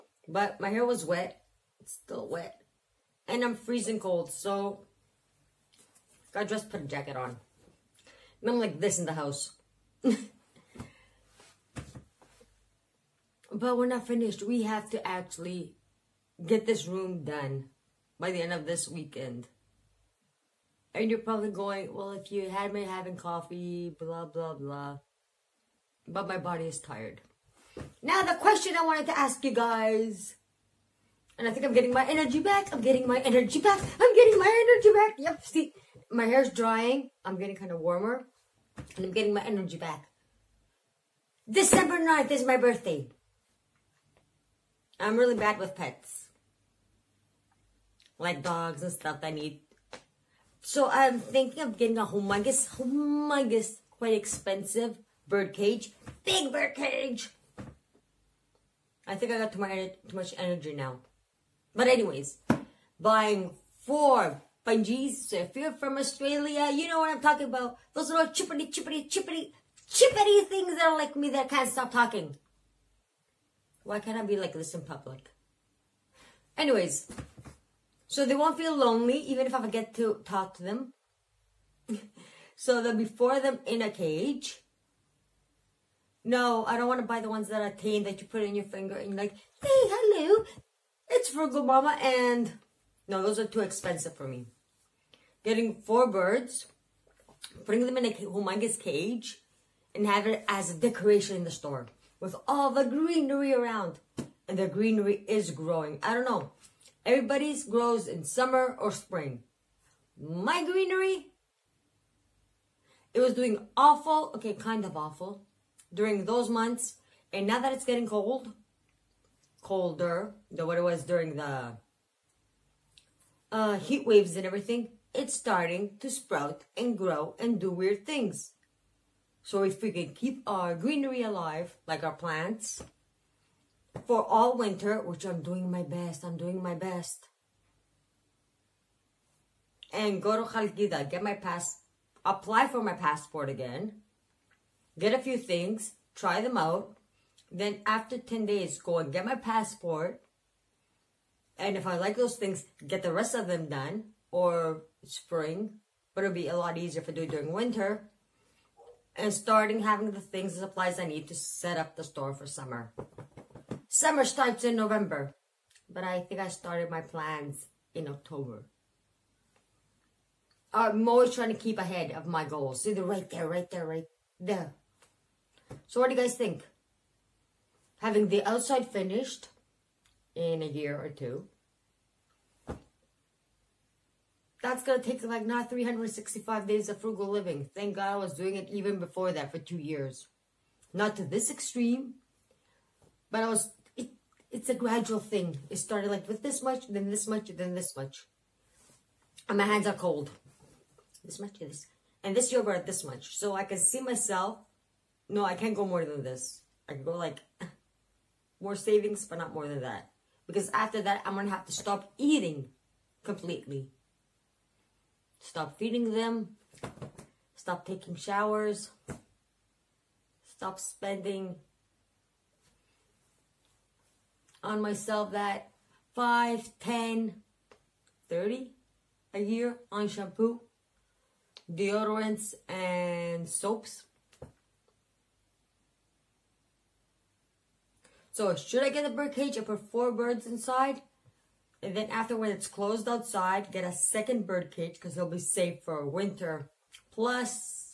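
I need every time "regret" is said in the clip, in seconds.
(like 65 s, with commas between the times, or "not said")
not said.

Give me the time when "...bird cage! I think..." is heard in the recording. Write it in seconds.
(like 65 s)
56 s.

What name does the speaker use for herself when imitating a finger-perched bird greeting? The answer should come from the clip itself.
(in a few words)
Frugal Mamma.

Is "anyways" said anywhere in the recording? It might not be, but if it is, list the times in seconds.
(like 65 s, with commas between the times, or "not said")
61 s, 76 s.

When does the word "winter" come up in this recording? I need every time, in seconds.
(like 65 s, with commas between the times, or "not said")
134 s, 157 s, 246 s.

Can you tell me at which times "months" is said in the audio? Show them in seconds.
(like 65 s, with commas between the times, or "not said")
116 s.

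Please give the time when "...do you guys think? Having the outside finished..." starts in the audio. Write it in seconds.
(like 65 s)
176 s.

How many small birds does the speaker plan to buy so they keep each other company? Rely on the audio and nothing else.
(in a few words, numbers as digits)
4.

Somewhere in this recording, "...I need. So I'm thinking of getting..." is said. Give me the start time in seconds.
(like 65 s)
49 s.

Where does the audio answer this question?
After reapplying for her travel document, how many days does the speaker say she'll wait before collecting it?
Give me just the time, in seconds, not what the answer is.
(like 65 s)
148 s.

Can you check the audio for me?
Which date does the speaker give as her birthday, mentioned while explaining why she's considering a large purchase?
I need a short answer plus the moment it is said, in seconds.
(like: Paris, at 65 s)
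December 9, at 41 s.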